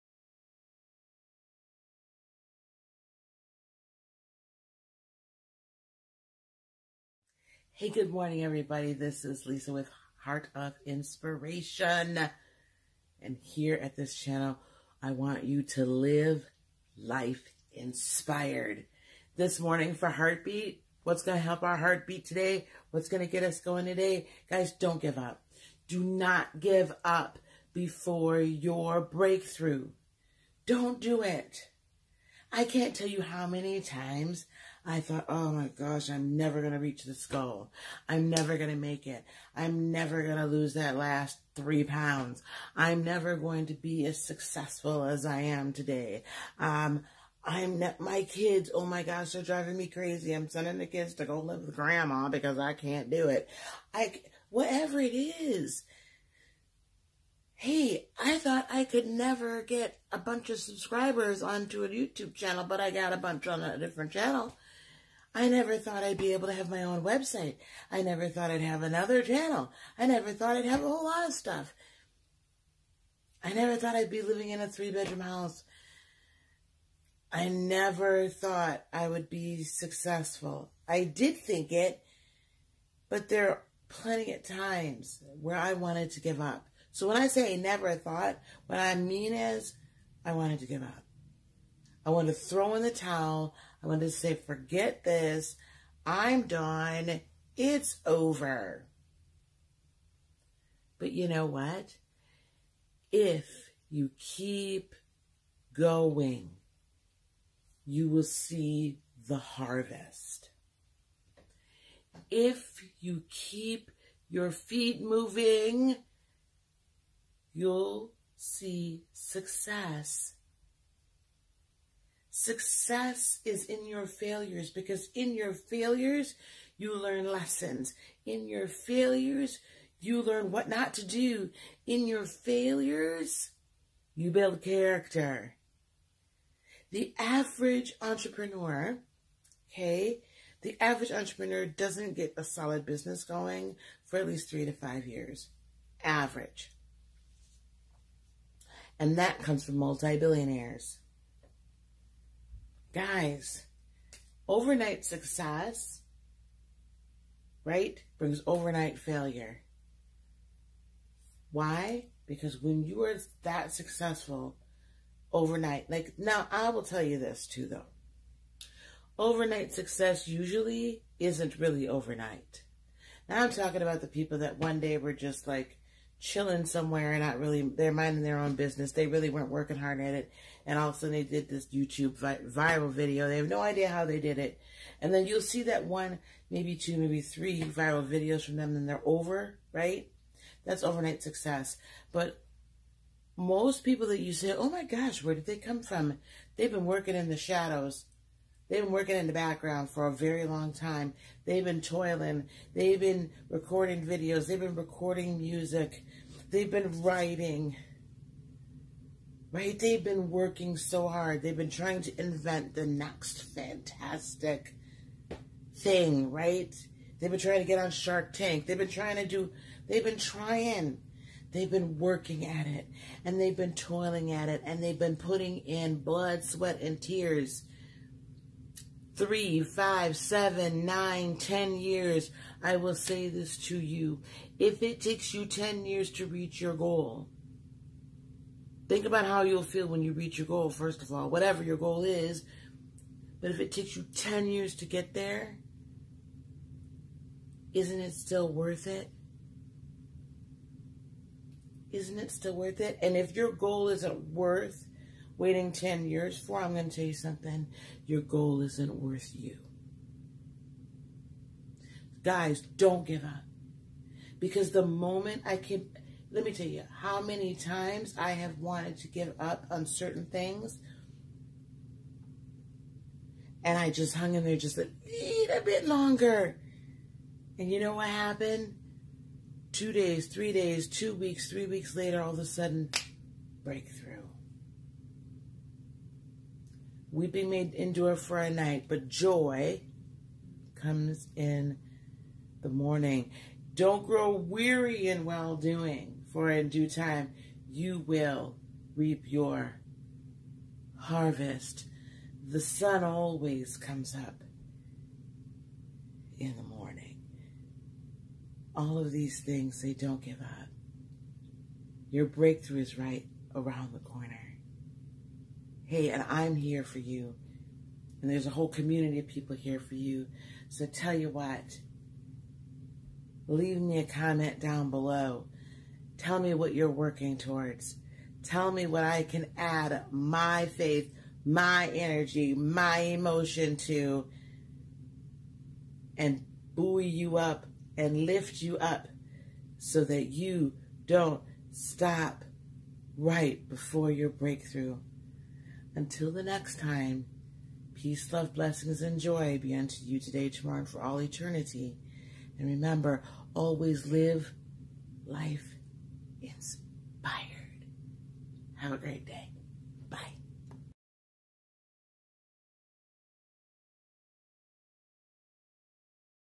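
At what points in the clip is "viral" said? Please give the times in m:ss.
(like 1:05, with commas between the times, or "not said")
3:02, 3:07.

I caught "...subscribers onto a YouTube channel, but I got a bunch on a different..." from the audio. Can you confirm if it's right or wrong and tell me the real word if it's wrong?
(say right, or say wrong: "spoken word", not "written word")
right.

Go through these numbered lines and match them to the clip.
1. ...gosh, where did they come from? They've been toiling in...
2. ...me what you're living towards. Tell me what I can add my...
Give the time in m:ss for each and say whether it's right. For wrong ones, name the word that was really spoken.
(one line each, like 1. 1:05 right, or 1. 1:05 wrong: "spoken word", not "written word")
1. 3:14 wrong: "working", not "toiling"
2. 5:26 wrong: "working", not "living".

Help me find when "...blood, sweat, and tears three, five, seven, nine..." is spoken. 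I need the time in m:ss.
3:46.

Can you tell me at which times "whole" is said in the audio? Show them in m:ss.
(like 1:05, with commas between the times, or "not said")
1:10, 5:18.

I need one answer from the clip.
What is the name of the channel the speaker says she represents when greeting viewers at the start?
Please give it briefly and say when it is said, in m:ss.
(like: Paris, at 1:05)
Heart of Inspiration, at 0:10.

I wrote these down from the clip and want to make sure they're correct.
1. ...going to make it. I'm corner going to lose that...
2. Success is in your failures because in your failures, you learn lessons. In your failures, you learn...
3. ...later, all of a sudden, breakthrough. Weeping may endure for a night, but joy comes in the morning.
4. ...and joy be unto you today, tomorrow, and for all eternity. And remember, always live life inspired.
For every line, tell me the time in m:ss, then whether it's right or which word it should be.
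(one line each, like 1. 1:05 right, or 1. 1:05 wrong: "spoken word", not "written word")
1. 0:38 wrong: "never", not "corner"
2. 2:02 right
3. 4:41 right
4. 5:49 right.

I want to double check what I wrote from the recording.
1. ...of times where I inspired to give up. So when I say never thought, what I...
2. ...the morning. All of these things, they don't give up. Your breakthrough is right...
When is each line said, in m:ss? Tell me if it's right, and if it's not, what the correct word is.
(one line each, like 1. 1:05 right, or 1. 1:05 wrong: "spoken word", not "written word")
1. 1:24 wrong: "wanted", not "inspired"
2. 5:06 right.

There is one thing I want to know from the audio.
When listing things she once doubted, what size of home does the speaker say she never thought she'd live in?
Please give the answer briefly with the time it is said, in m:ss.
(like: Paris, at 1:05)
three bedroom house, at 1:14.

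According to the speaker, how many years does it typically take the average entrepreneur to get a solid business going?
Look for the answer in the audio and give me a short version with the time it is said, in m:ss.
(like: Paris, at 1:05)
3 to 5 years, at 2:24.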